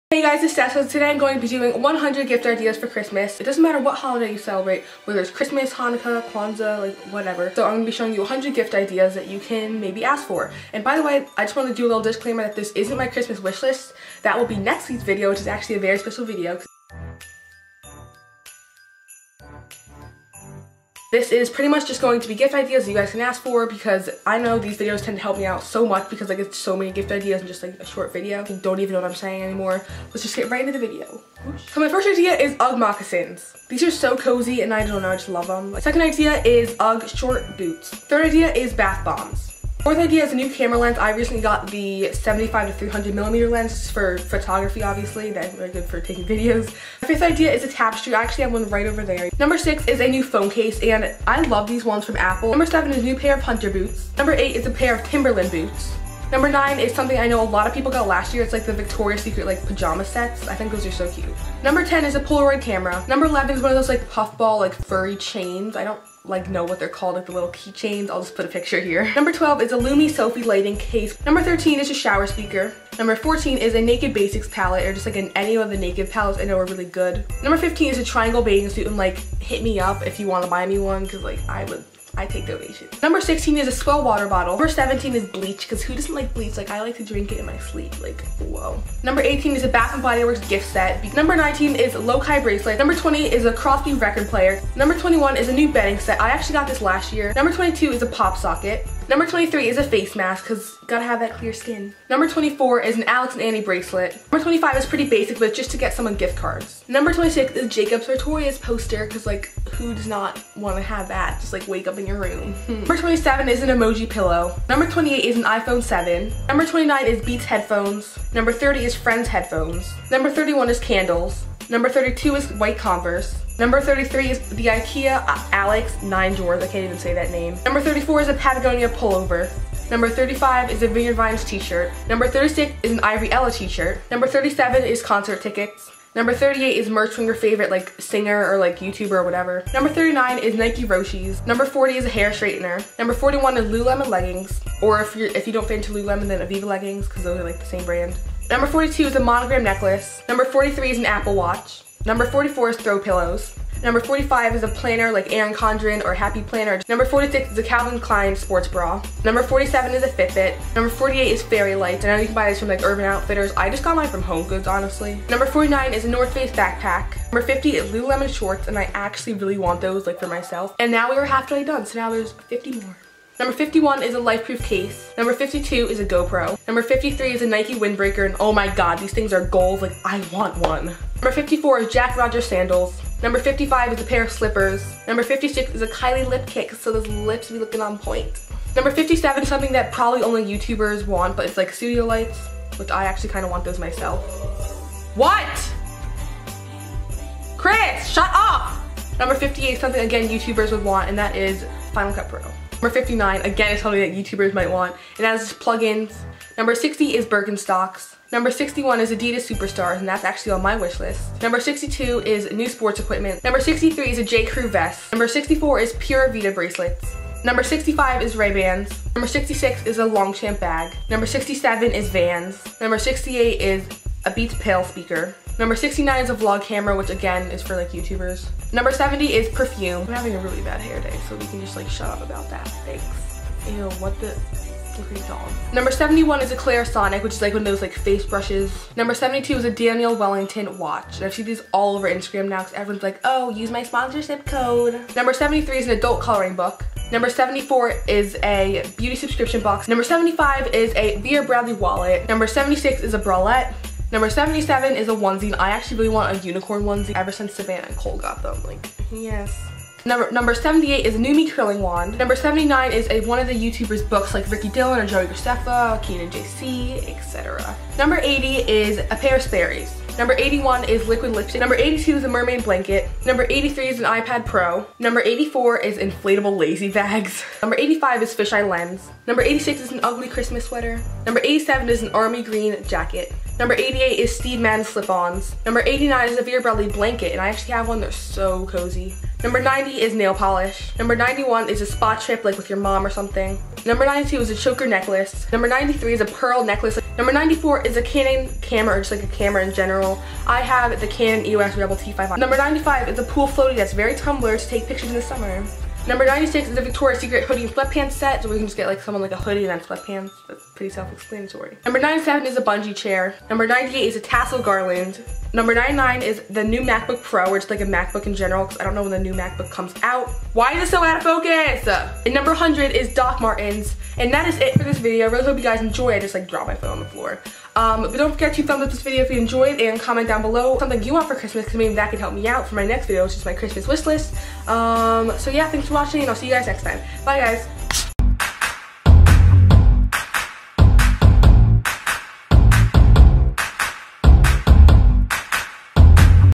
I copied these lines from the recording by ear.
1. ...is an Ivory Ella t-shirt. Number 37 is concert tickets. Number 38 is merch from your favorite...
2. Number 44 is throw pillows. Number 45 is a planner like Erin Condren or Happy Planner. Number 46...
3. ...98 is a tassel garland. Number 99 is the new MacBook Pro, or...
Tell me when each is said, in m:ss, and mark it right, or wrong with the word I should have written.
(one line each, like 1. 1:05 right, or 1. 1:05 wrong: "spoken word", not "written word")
1. 2:12 right
2. 2:32 right
3. 5:13 right.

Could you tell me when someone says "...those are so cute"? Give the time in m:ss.
1:00.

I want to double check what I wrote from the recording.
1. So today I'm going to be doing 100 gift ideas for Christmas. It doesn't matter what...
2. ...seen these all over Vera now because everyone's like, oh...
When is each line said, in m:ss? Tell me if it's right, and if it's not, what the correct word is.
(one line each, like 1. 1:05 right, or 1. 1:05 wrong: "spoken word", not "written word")
1. 0:00 right
2. 4:01 wrong: "Instagram", not "Vera".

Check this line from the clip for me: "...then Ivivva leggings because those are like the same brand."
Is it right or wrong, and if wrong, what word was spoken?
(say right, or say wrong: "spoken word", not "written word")
right.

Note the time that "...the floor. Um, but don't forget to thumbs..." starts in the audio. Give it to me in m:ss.
5:26.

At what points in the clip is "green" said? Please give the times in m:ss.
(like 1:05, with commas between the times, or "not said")
4:42.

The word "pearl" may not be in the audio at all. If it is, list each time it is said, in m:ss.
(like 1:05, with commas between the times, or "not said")
4:56.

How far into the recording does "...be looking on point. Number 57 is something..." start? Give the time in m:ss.
3:07.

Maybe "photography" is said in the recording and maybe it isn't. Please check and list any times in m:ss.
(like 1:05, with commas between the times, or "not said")
0:44.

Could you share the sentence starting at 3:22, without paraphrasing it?
Number 59, again, is something that YouTubers might want.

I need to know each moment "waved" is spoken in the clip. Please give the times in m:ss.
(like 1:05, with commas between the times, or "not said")
not said.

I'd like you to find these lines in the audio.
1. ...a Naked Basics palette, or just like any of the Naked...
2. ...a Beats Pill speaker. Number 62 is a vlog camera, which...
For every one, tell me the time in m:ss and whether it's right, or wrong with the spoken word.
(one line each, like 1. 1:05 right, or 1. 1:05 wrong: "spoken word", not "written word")
1. 1:13 right
2. 3:44 wrong: "69", not "62".